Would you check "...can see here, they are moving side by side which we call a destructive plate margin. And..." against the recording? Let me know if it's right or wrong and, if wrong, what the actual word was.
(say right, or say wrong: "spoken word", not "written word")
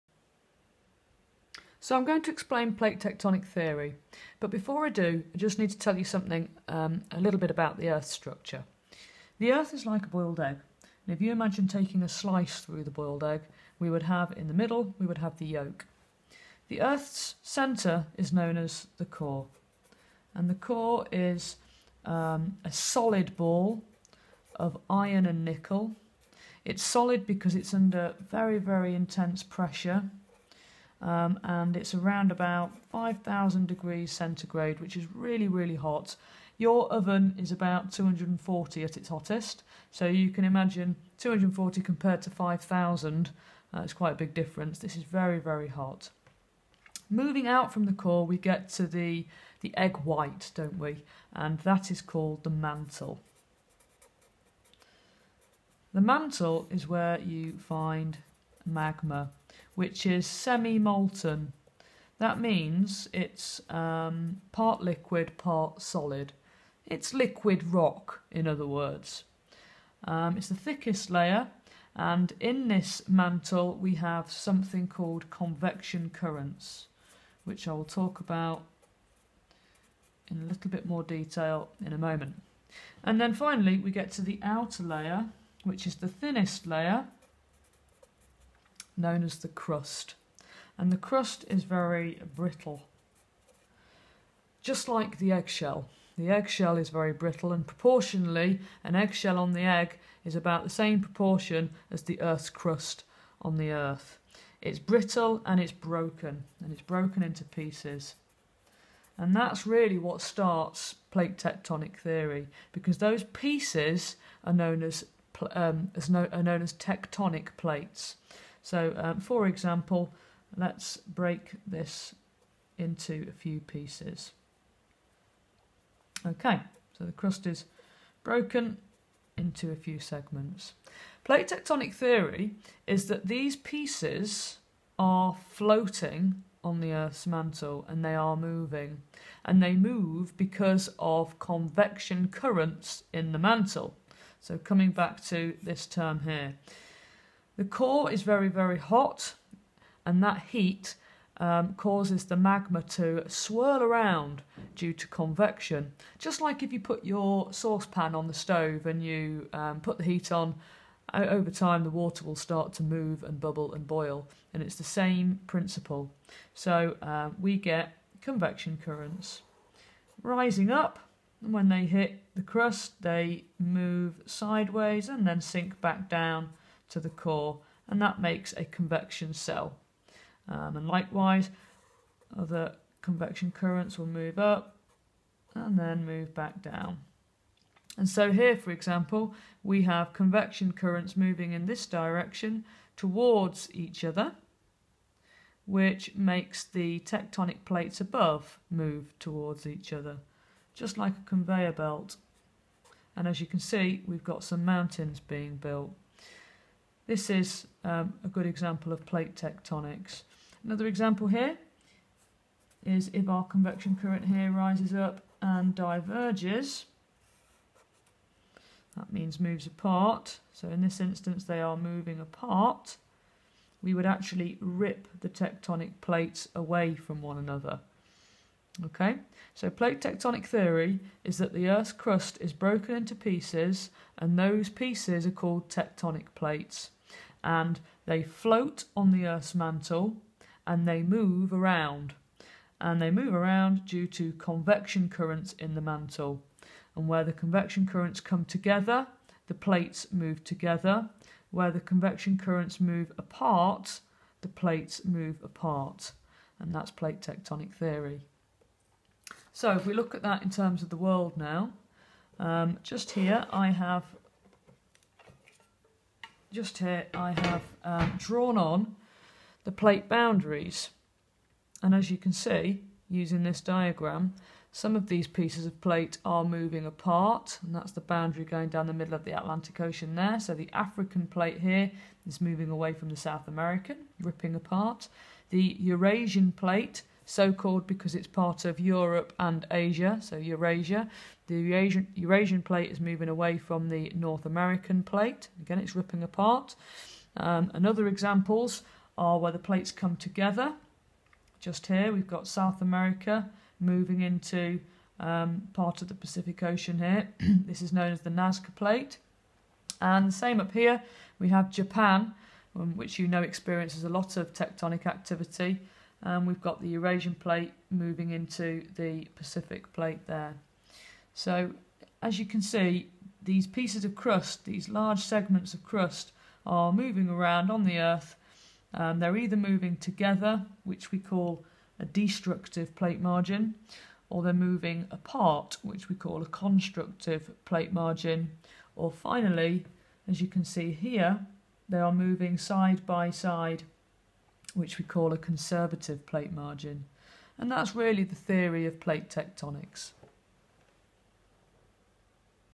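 wrong: "conservative", not "destructive".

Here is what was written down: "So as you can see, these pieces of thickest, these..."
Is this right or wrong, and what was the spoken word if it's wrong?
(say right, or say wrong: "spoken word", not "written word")
wrong: "crust", not "thickest".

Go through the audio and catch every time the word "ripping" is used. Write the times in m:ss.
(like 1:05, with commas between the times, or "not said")
4:44, 4:55.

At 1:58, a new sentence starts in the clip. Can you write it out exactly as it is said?
So um, for example, let's break this into a few pieces.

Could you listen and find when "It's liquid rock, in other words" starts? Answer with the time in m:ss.
1:06.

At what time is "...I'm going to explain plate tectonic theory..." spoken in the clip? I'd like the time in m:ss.
0:01.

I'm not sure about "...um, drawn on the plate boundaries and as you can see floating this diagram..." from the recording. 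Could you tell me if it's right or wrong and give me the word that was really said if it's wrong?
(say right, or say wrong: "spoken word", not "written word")
wrong: "using", not "floating".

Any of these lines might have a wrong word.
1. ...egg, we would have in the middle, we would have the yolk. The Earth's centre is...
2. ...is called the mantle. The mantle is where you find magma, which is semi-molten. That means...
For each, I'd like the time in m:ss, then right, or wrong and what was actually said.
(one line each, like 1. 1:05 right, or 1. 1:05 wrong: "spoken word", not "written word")
1. 0:13 right
2. 0:51 right.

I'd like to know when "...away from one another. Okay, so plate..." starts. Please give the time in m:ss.
3:46.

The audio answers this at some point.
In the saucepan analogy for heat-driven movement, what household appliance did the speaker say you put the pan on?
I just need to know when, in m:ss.
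2:38.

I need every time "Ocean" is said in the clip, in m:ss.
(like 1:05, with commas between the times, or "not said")
4:39, 5:06.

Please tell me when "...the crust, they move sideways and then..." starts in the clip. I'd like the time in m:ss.
2:52.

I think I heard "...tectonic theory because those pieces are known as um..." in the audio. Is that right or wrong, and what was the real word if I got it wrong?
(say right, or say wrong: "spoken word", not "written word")
right.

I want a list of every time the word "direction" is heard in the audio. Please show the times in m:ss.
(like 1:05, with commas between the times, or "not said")
3:11.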